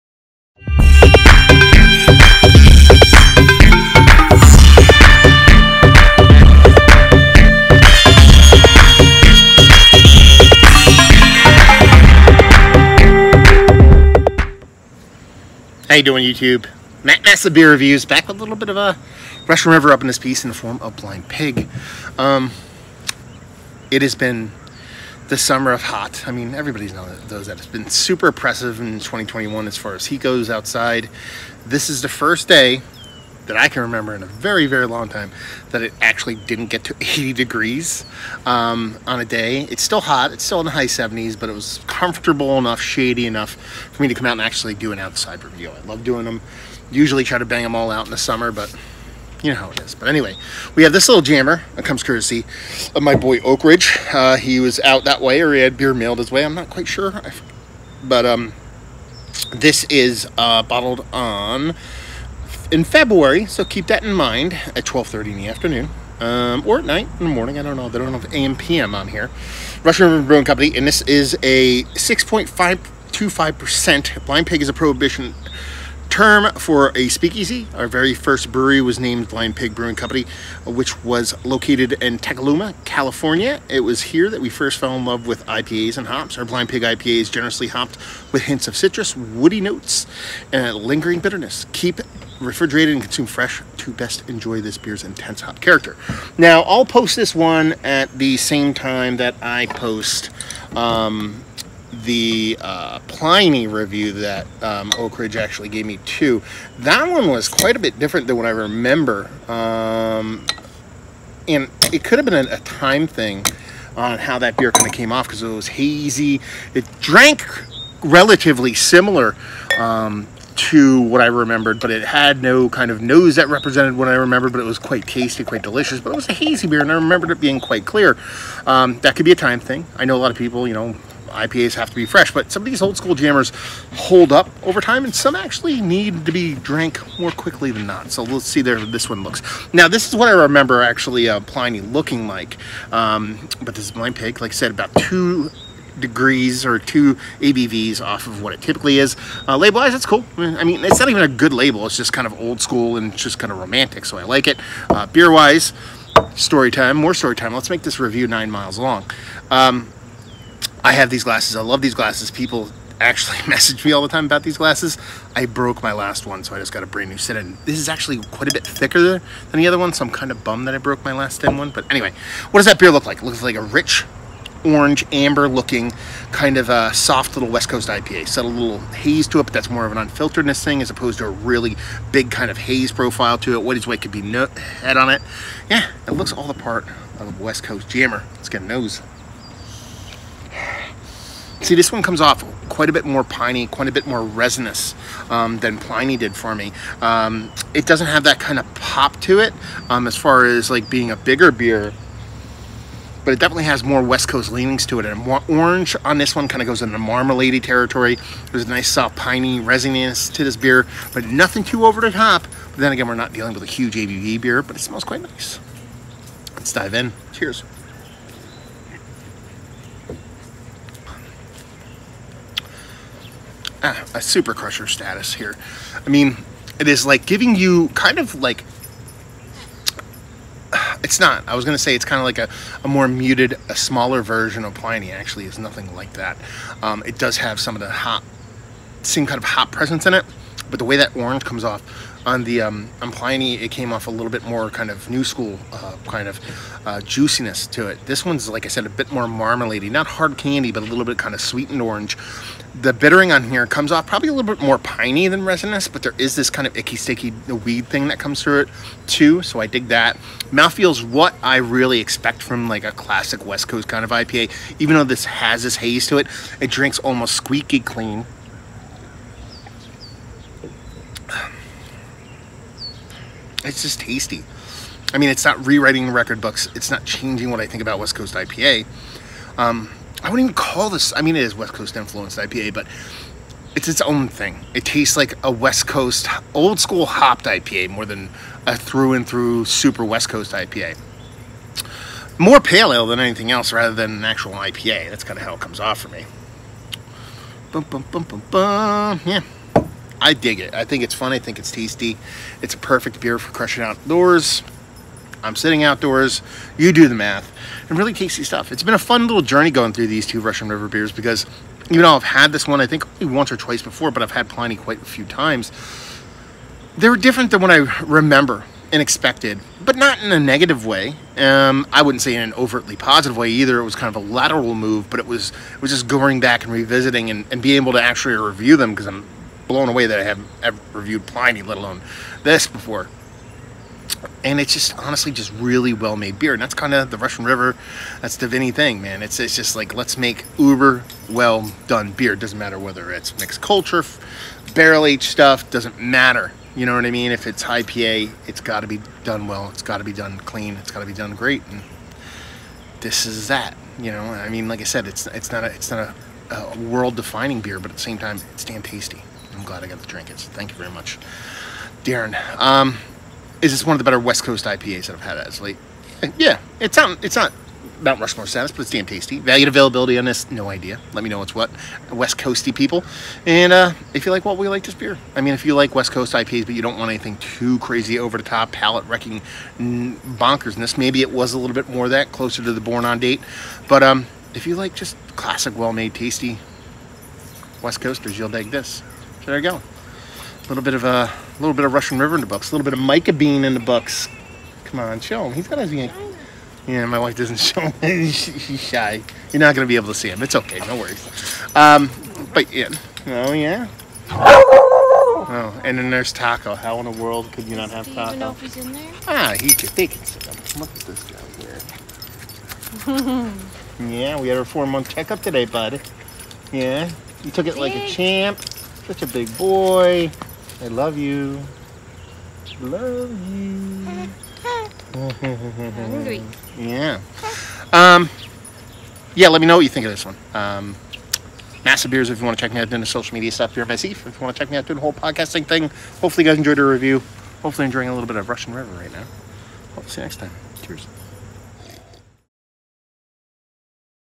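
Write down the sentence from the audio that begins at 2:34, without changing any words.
Uh, Beer-wise, story time, more story time.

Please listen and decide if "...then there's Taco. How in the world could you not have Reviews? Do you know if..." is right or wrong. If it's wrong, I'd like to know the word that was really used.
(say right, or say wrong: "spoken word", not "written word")
wrong: "Taco", not "Reviews".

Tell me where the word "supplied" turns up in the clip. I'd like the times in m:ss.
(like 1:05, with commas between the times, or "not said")
not said.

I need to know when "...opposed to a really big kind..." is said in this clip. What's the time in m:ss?
3:00.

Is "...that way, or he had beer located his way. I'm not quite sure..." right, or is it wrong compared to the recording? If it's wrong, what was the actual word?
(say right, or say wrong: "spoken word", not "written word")
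wrong: "mailed", not "located".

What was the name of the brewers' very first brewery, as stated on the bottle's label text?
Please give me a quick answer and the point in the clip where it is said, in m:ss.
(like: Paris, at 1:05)
Blind Pig Brewing Company, at 1:19.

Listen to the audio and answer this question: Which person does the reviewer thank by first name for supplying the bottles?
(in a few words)
Darren.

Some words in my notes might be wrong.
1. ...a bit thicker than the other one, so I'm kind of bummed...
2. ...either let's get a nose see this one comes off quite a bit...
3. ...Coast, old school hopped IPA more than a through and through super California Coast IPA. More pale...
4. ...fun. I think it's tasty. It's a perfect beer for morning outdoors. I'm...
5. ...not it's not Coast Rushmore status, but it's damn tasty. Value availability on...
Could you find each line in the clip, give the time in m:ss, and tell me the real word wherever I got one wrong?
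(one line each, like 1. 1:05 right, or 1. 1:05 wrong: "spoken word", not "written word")
1. 2:48 right
2. 3:07 wrong: "jammer", not "either"
3. 4:45 wrong: "West", not "California"
4. 5:01 wrong: "crushing", not "morning"
5. 6:06 wrong: "Mount", not "Coast".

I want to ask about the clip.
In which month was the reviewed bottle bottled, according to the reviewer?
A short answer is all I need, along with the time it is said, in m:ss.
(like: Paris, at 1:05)
February, at 1:02.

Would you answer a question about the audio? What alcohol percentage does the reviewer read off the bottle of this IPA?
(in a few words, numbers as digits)
6.525%.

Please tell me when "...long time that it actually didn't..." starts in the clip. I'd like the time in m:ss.
0:34.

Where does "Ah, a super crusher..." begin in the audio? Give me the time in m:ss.
3:43.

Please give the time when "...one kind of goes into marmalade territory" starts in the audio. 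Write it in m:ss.
3:26.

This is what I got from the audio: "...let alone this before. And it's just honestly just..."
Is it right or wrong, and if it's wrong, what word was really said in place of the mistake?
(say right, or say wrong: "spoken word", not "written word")
right.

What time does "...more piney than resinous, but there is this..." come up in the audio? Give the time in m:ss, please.
4:14.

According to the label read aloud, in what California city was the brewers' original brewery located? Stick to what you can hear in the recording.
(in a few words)
Temecula.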